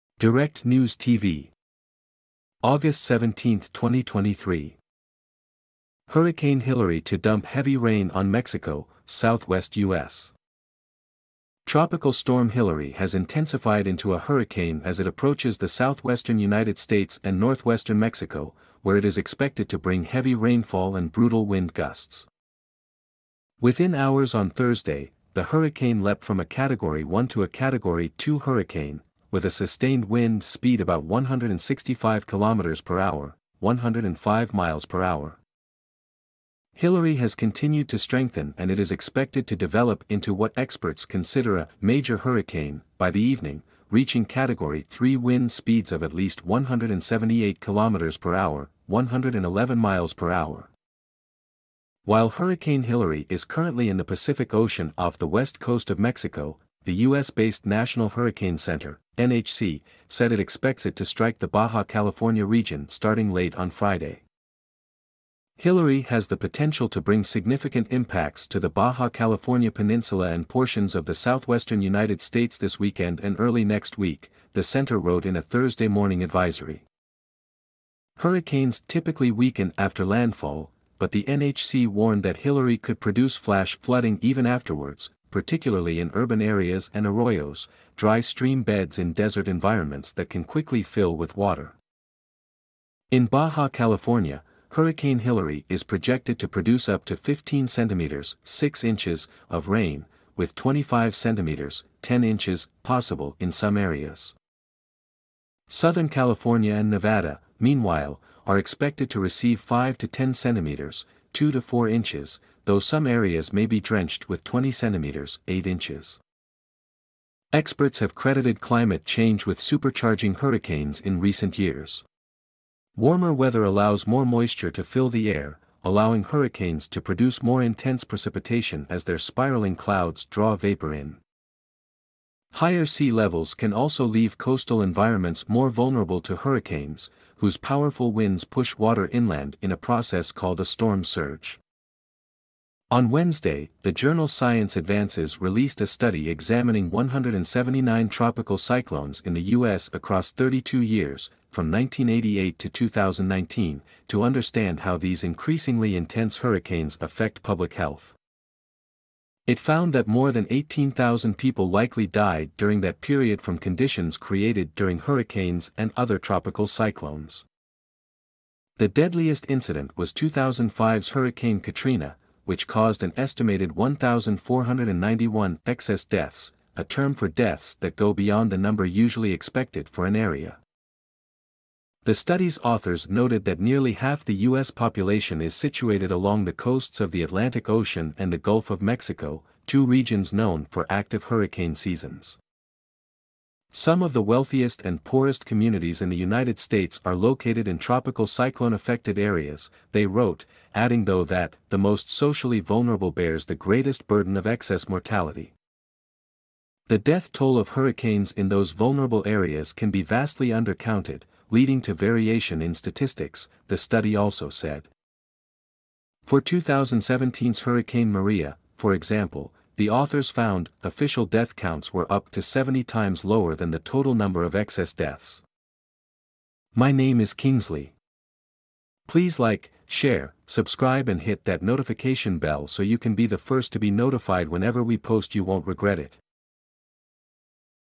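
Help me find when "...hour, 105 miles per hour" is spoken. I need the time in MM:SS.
00:32.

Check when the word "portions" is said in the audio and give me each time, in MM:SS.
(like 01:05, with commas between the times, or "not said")
01:10.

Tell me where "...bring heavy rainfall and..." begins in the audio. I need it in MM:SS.
00:19.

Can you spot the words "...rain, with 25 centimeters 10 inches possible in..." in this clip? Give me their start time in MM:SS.
01:39.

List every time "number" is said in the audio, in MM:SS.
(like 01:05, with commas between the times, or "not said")
02:58, 03:44.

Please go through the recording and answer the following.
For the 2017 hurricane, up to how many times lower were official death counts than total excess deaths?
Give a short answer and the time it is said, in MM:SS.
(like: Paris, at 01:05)
70, at 03:42.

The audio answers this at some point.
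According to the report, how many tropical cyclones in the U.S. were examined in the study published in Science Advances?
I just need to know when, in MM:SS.
02:26.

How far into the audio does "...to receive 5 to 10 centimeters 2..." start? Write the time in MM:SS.
01:49.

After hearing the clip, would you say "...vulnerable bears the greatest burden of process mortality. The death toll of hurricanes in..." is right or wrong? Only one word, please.
wrong.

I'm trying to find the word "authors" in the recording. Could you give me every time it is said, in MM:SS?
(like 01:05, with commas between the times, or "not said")
03:02, 03:39.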